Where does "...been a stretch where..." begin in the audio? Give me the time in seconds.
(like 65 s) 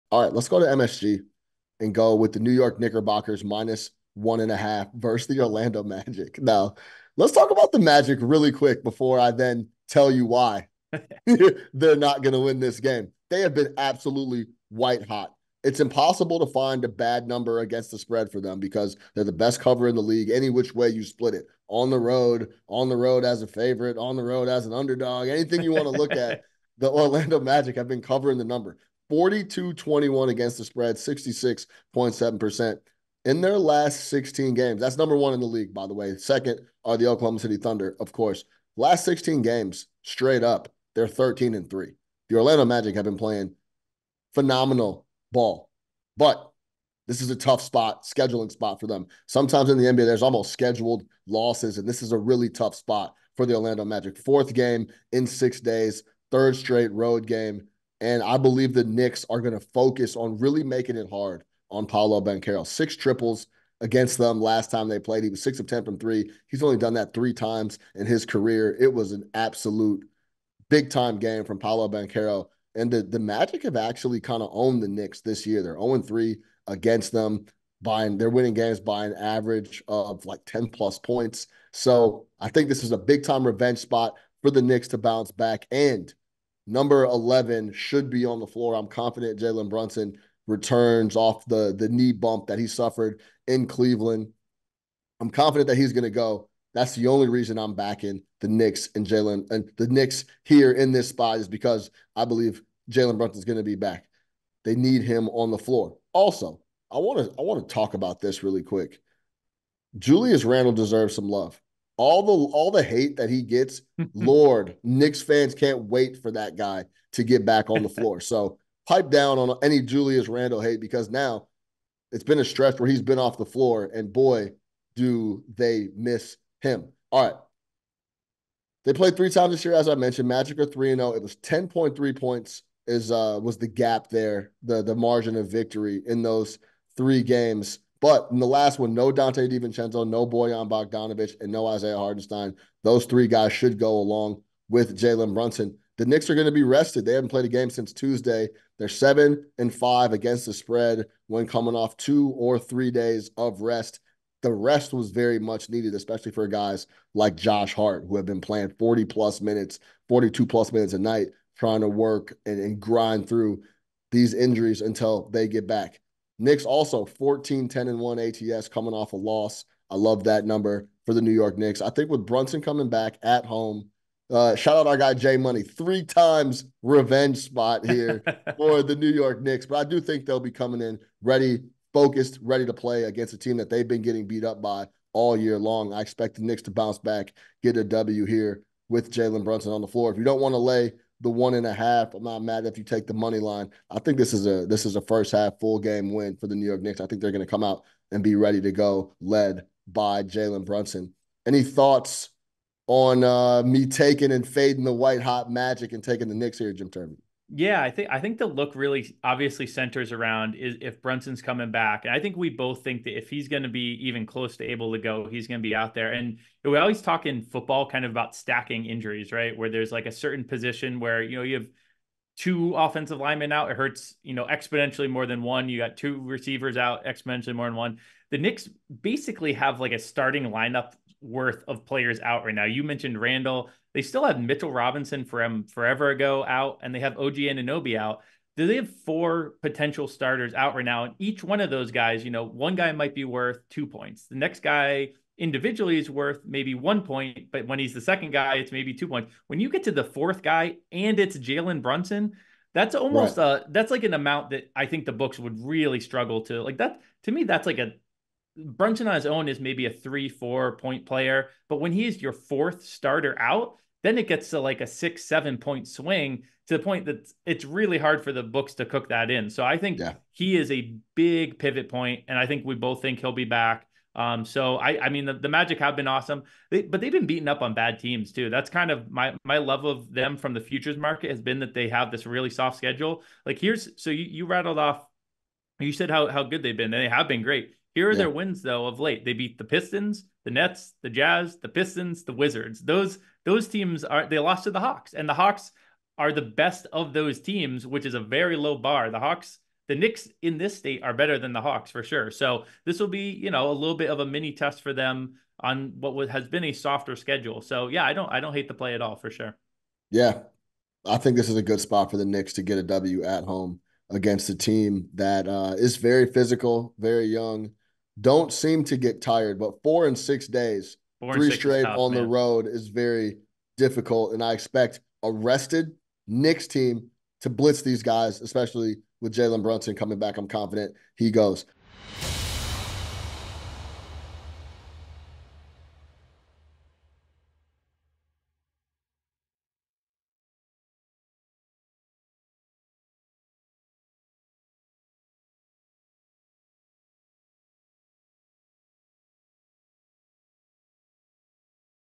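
122 s.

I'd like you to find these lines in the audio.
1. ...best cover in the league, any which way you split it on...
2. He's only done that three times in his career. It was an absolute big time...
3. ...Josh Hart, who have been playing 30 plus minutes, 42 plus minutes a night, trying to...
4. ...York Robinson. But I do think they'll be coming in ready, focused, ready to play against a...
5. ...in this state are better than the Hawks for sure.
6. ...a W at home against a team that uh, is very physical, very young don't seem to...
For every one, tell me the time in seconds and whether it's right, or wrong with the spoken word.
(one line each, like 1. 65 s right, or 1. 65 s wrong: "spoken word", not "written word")
1. 19 s right
2. 66 s right
3. 157 s wrong: "40", not "30"
4. 179 s wrong: "Knicks", not "Robinson"
5. 300 s right
6. 312 s right.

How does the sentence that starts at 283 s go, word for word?
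Like here's so you, you rattled off, you said how how good they've been, they have been great.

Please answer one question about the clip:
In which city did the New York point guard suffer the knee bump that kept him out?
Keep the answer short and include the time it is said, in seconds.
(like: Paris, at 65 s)
Cleveland, at 93 s.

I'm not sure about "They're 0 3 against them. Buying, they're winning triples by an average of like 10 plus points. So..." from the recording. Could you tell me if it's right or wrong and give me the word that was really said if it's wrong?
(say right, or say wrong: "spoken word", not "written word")
wrong: "games", not "triples".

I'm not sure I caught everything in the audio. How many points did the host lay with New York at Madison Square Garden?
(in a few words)
1.5.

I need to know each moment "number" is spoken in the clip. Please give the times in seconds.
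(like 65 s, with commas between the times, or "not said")
17 s, 28 s, 34 s, 86 s, 170 s.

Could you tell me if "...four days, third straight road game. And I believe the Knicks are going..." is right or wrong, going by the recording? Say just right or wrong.
wrong.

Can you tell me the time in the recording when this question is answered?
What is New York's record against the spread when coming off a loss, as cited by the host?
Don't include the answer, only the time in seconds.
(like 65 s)
167 s.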